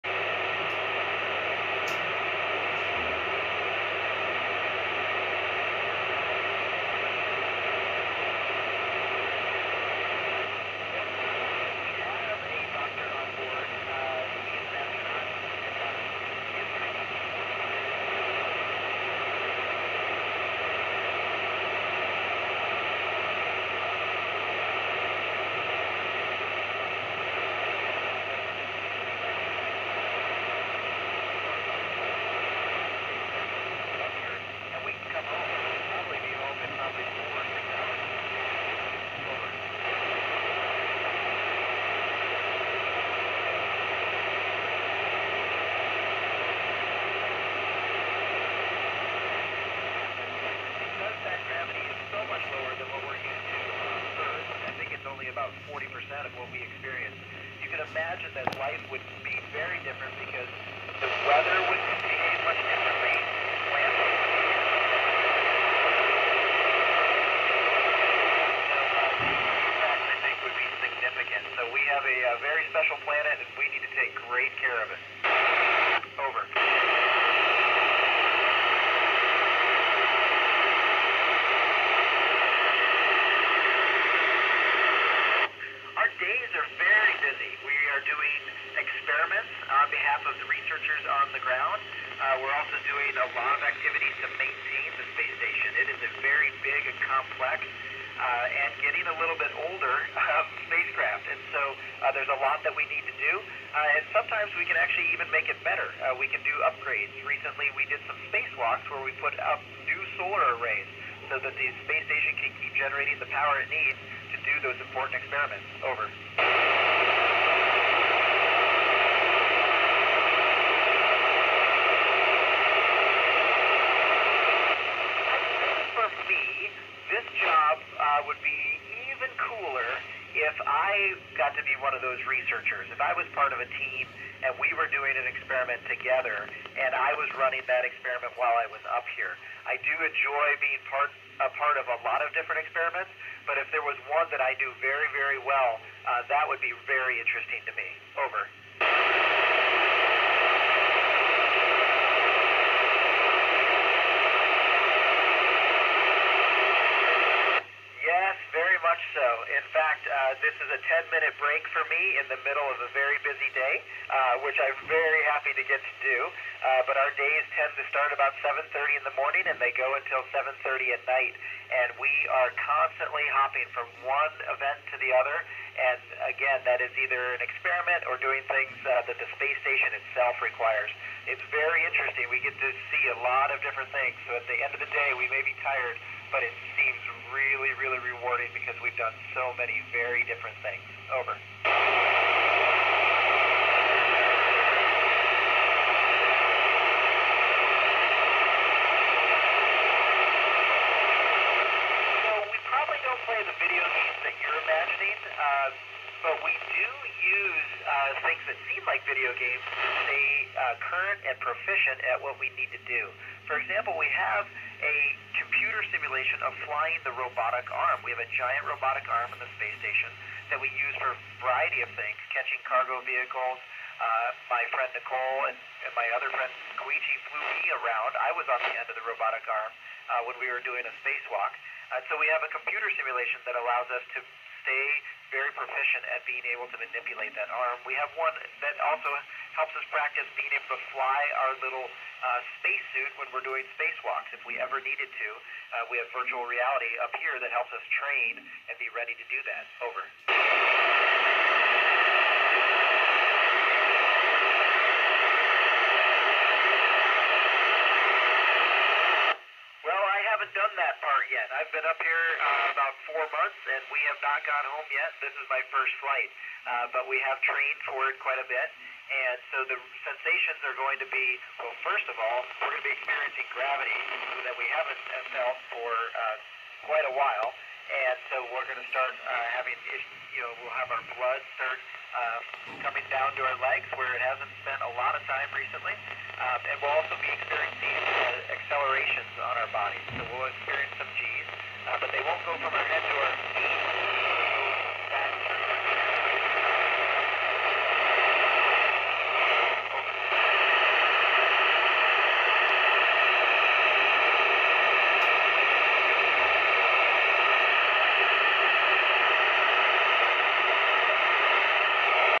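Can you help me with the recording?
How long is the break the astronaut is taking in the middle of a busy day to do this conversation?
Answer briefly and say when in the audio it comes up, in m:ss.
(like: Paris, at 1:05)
10 minutes, at 2:40.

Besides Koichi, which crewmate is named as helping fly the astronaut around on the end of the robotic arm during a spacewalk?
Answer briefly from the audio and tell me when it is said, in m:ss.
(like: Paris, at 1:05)
Nicole, at 3:44.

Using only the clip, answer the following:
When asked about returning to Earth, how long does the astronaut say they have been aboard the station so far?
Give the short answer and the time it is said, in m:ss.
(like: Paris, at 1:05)
about four months, at 4:22.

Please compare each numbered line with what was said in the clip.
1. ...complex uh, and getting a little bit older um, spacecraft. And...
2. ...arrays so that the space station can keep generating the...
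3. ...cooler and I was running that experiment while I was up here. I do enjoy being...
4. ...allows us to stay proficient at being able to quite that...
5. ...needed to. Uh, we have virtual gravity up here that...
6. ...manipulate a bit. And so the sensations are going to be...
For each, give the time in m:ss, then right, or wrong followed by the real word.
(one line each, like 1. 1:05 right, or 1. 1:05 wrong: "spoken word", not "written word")
1. 1:37 right
2. 1:50 right
3. 2:15 wrong: "together", not "cooler"
4. 3:53 wrong: "manipulate", not "quite"
5. 4:04 wrong: "reality", not "gravity"
6. 4:28 wrong: "quite", not "manipulate".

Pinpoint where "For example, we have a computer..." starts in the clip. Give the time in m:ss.
3:33.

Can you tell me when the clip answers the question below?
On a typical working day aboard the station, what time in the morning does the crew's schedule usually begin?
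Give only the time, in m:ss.
2:48.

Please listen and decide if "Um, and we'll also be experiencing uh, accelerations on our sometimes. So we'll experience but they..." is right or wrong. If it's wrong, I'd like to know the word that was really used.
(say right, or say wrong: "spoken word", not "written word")
wrong: "bodies", not "sometimes".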